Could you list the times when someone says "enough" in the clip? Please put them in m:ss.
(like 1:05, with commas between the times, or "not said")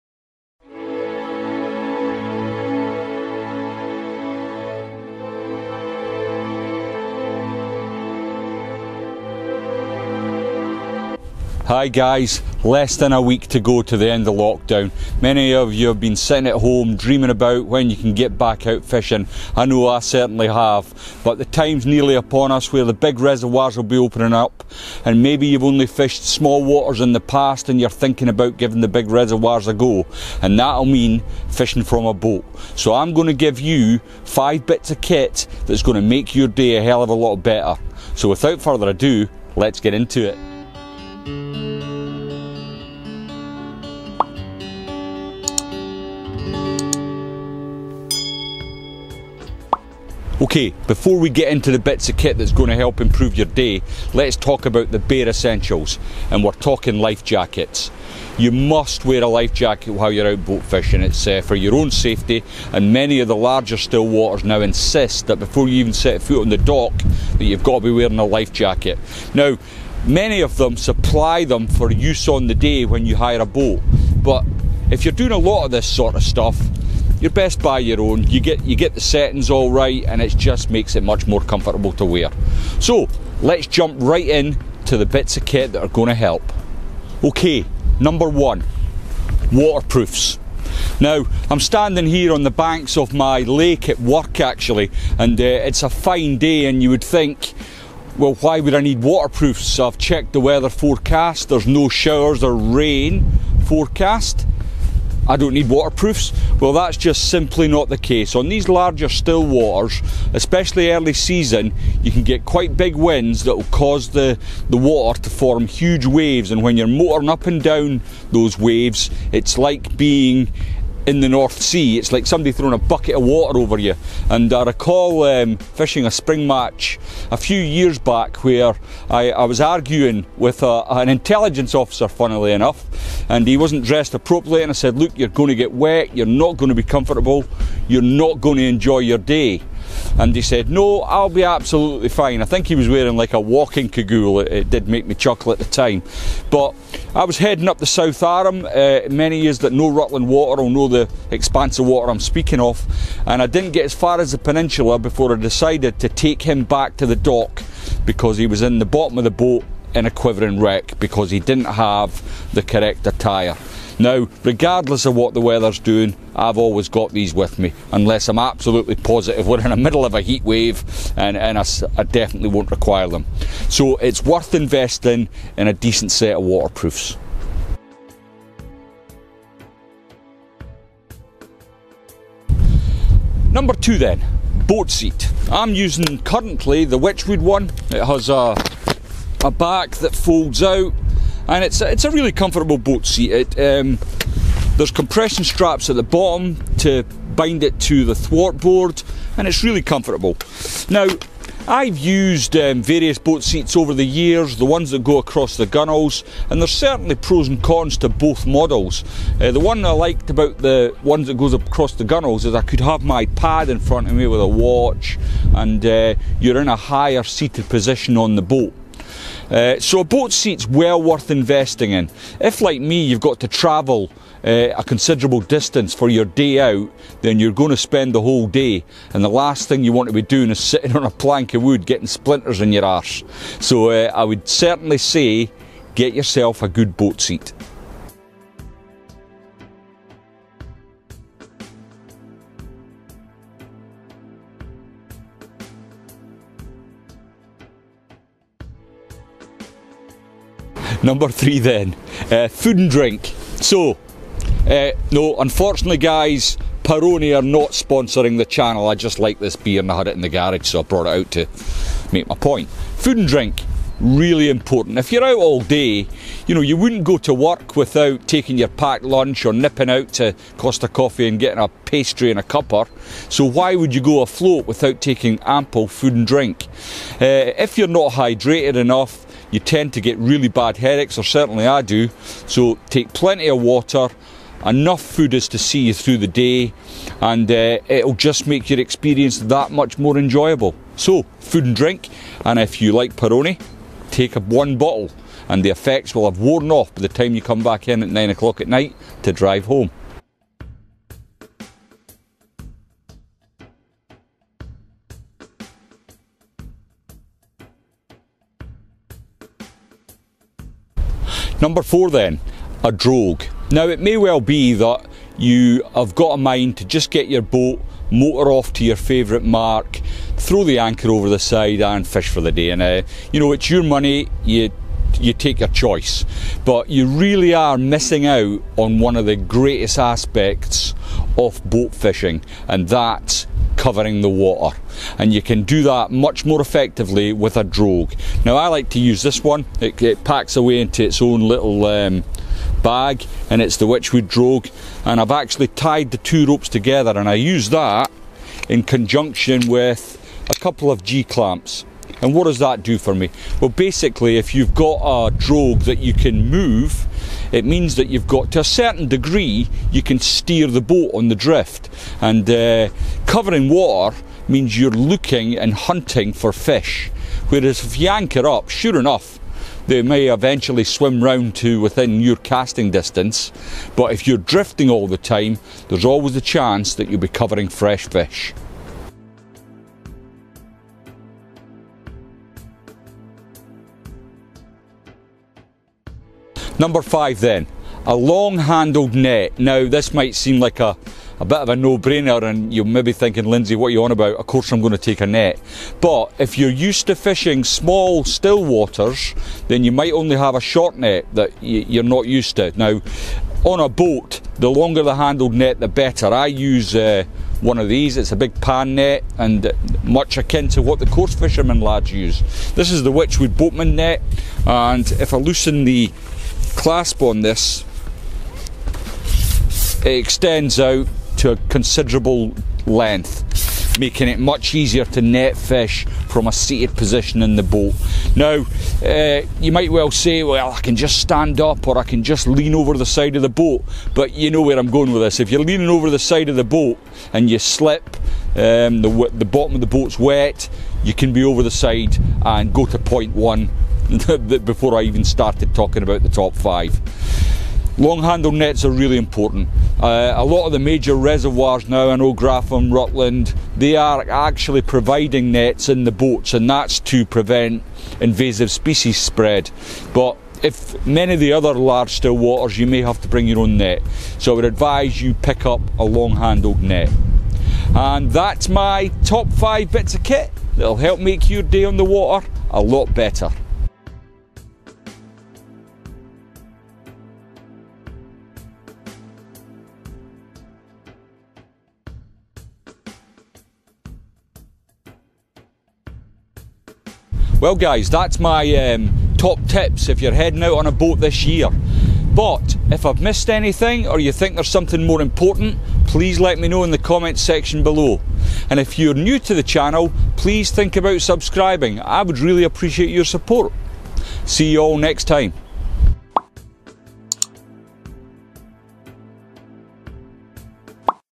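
2:12, 4:38, 4:44, 6:08.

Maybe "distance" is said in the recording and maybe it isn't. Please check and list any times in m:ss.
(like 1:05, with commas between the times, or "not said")
3:45, 6:12.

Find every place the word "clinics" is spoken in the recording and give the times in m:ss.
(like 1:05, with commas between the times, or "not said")
not said.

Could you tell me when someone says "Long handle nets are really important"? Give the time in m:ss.
7:27.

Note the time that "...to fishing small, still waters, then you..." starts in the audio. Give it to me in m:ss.
6:37.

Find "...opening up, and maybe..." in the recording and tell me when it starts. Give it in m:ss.
0:23.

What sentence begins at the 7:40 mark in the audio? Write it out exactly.
But if many of the other large still waters, you may have to bring your own net.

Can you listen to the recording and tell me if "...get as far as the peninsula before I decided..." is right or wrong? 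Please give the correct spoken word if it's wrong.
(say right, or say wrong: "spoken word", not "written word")
right.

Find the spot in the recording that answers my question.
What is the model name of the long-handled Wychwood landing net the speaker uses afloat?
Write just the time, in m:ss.
6:53.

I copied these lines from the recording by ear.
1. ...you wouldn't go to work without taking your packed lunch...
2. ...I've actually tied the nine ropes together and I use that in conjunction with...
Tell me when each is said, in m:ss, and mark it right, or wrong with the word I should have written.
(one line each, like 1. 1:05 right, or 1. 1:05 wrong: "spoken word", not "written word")
1. 4:26 right
2. 5:45 wrong: "two", not "nine".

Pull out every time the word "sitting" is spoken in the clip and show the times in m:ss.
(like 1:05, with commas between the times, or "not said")
0:16, 3:50.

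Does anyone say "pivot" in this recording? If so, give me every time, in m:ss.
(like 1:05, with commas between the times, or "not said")
not said.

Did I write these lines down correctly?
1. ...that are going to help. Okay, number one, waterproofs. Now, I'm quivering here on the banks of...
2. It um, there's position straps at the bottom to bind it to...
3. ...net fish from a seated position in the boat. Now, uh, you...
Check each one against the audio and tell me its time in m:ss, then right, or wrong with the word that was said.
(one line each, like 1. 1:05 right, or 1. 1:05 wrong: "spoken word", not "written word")
1. 1:25 wrong: "standing", not "quivering"
2. 3:13 wrong: "compression", not "position"
3. 7:05 right.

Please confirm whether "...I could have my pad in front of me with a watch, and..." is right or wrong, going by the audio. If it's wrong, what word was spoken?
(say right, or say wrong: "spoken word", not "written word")
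right.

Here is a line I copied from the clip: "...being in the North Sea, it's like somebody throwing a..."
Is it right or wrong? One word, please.
right.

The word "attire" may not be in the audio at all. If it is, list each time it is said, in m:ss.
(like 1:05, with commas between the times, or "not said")
2:43.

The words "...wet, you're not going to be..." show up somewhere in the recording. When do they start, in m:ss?
2:15.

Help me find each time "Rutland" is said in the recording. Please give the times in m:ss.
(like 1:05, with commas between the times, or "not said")
2:29, 7:32.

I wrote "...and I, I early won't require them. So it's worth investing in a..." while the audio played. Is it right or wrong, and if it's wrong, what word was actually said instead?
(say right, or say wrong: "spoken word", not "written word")
wrong: "definitely", not "early".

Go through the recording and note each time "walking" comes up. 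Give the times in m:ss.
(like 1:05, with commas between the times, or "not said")
2:23.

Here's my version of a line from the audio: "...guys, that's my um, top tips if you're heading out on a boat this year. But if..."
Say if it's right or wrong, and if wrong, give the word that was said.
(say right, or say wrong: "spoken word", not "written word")
right.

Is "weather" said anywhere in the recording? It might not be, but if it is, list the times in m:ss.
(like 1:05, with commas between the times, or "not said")
1:40, 2:45.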